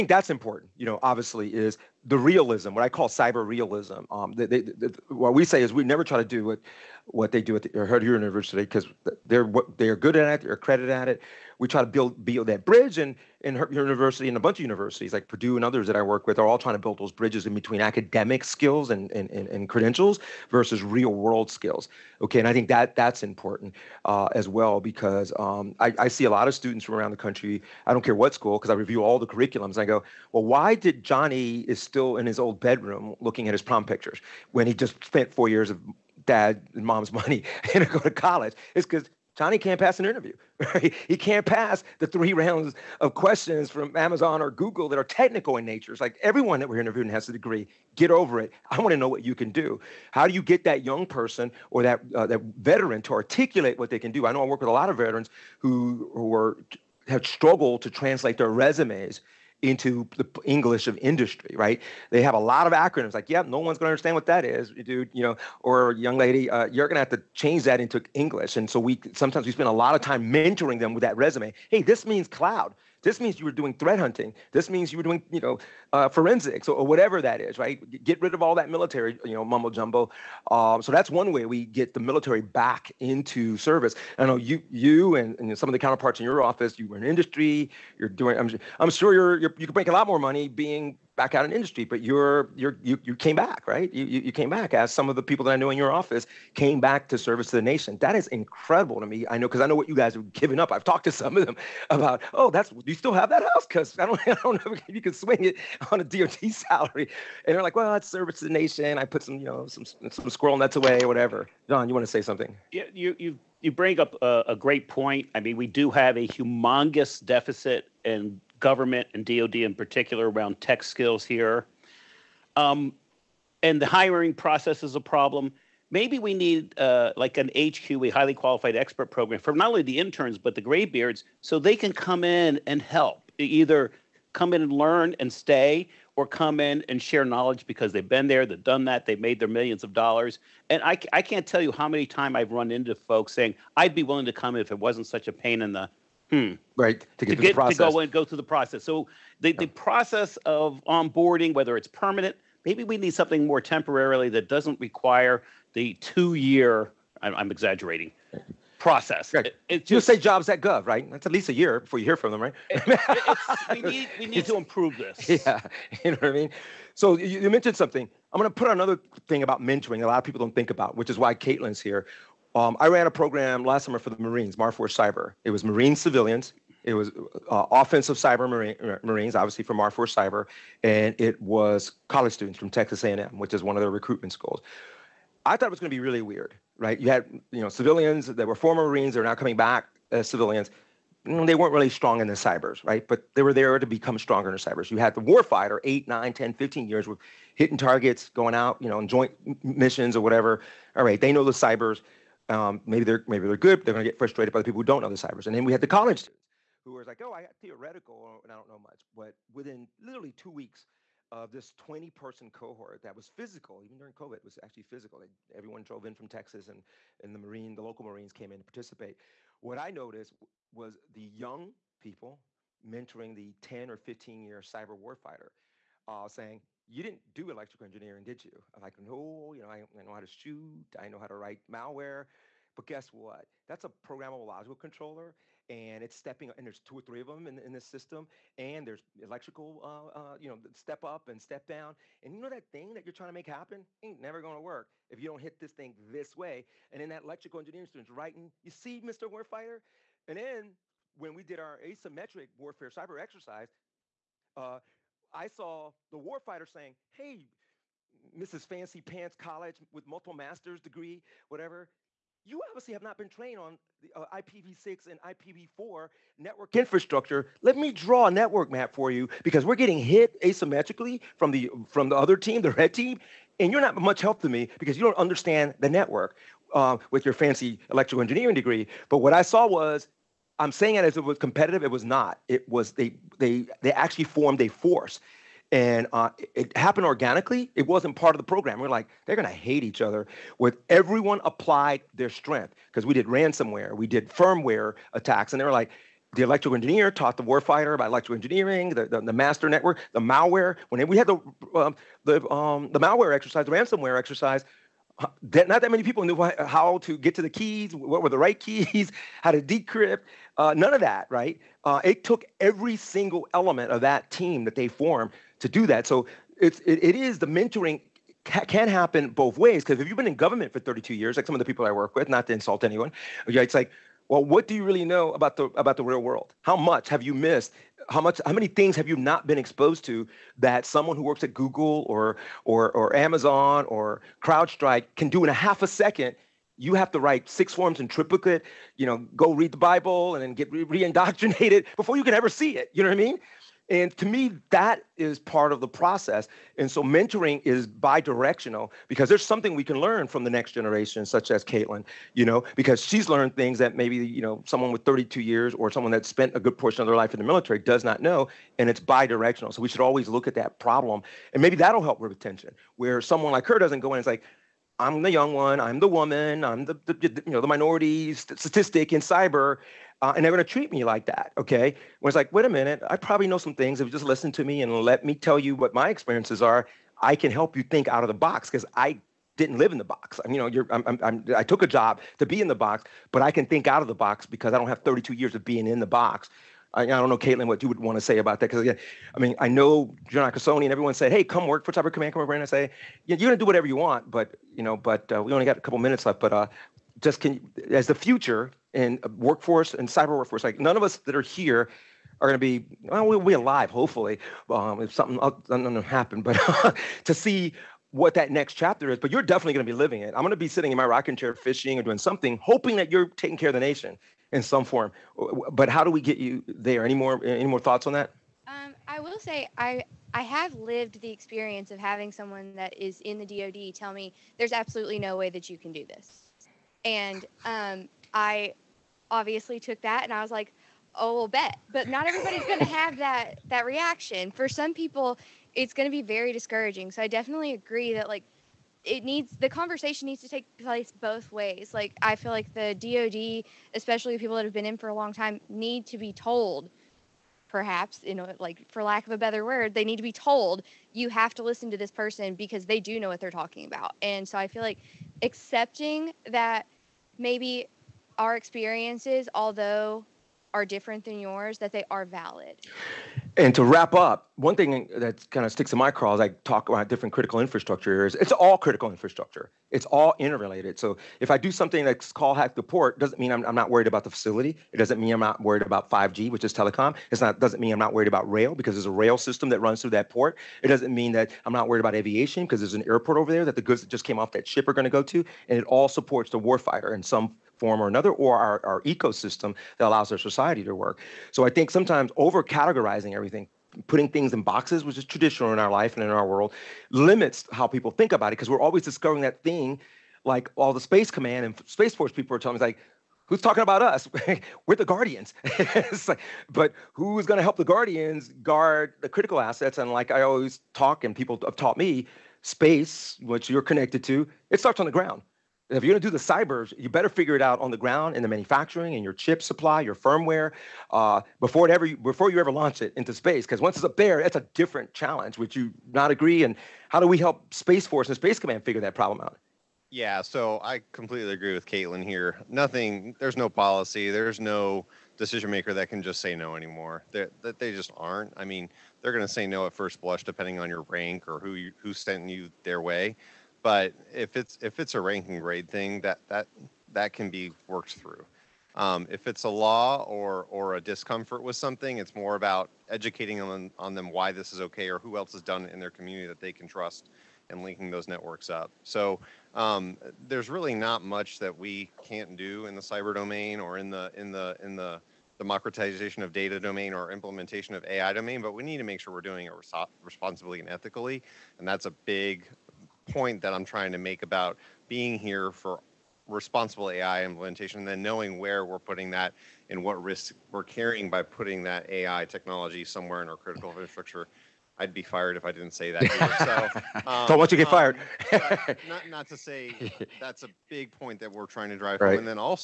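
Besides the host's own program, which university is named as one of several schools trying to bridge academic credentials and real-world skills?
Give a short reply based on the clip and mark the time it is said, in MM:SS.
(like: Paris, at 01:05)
Purdue, at 00:15.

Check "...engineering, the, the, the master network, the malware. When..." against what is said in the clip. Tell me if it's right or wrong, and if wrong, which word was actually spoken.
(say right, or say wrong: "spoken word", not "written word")
right.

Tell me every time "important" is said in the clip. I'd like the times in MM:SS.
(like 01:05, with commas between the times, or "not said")
00:00, 00:23.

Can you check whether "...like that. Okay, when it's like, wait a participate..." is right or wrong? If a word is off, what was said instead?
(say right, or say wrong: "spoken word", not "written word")
wrong: "minute", not "participate".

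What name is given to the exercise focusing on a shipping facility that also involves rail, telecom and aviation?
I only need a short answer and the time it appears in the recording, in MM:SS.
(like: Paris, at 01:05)
hack the port, at 07:52.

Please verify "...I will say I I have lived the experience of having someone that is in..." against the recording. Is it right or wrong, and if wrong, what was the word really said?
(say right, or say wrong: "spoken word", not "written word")
right.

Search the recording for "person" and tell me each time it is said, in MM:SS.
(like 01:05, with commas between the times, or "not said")
00:51, 03:32, 07:32.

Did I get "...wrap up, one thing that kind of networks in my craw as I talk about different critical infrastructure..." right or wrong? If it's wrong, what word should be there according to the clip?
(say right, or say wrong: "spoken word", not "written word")
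wrong: "sticks", not "networks".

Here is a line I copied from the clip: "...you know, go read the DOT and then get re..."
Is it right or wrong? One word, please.
wrong.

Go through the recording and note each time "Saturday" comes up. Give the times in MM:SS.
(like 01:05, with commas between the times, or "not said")
not said.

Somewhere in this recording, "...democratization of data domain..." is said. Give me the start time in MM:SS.
09:25.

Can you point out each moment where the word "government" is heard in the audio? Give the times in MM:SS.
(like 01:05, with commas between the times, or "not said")
01:58, 05:20.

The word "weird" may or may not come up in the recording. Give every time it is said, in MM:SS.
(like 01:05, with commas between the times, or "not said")
03:06.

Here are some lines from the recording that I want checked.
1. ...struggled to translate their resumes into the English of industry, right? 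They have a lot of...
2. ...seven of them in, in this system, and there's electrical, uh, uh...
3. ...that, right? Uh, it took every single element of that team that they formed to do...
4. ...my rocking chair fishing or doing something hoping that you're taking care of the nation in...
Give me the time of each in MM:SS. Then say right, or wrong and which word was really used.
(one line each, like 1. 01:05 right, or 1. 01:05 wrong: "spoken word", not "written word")
1. 00:57 right
2. 03:57 wrong: "three", not "seven"
3. 05:10 right
4. 06:50 right.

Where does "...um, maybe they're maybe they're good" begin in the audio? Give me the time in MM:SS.
03:22.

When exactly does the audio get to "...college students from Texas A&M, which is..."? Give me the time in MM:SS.
03:02.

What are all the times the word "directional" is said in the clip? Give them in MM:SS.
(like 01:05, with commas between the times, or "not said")
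05:47, 05:58.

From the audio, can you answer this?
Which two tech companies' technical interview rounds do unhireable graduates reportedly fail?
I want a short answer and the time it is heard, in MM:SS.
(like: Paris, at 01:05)
Amazon or Google, at 00:43.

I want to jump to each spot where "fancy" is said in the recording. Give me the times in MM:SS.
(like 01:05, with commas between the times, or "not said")
04:18, 04:37.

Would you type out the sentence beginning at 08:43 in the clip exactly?
Because once it's up there, that's a different challenge.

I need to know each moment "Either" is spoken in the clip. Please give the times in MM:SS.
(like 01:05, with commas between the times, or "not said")
02:13, 09:46.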